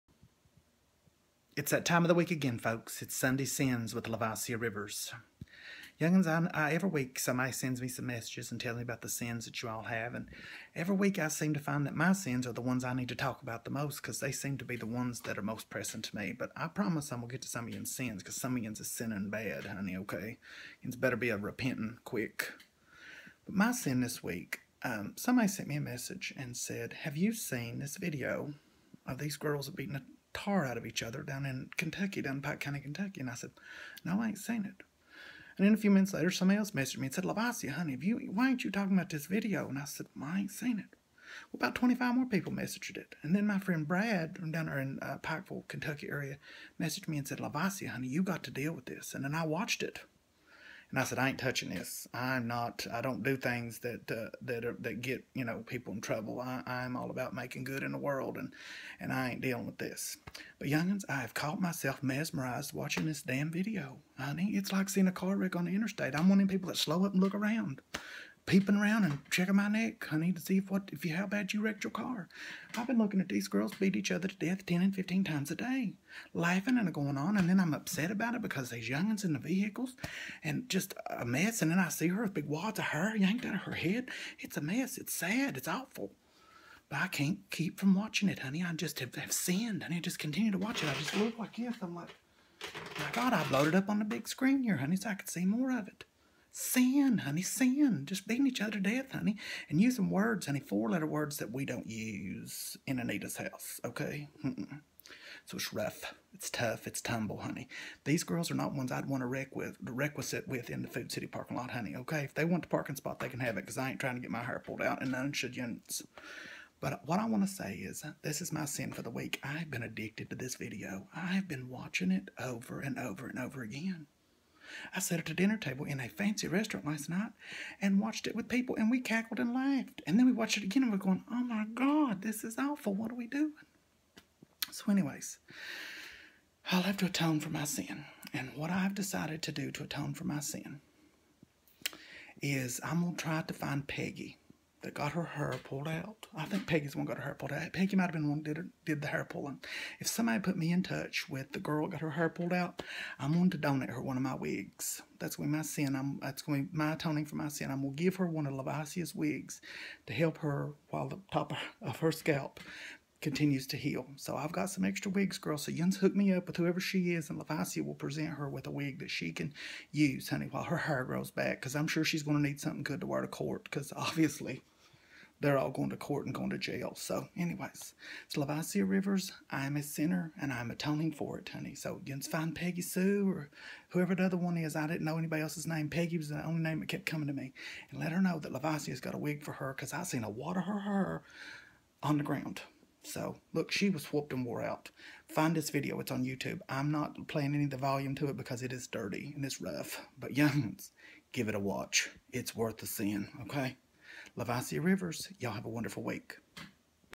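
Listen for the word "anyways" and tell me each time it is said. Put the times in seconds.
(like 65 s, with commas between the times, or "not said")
134 s, 177 s.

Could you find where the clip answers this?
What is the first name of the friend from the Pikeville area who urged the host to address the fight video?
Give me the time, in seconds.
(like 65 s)
43 s.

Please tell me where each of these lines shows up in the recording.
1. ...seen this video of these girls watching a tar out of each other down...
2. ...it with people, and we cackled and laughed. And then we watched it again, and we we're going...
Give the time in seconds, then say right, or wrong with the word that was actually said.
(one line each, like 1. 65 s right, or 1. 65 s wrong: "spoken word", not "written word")
1. 27 s wrong: "beating", not "watching"
2. 128 s right.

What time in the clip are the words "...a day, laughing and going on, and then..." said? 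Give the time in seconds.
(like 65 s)
75 s.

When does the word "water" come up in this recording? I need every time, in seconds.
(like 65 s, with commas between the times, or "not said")
190 s.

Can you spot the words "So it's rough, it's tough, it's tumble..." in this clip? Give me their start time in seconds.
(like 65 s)
105 s.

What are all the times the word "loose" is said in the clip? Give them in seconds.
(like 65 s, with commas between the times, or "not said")
not said.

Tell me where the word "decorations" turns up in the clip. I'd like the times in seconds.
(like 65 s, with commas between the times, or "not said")
not said.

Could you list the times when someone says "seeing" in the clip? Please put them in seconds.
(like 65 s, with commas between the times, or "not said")
64 s, 202 s.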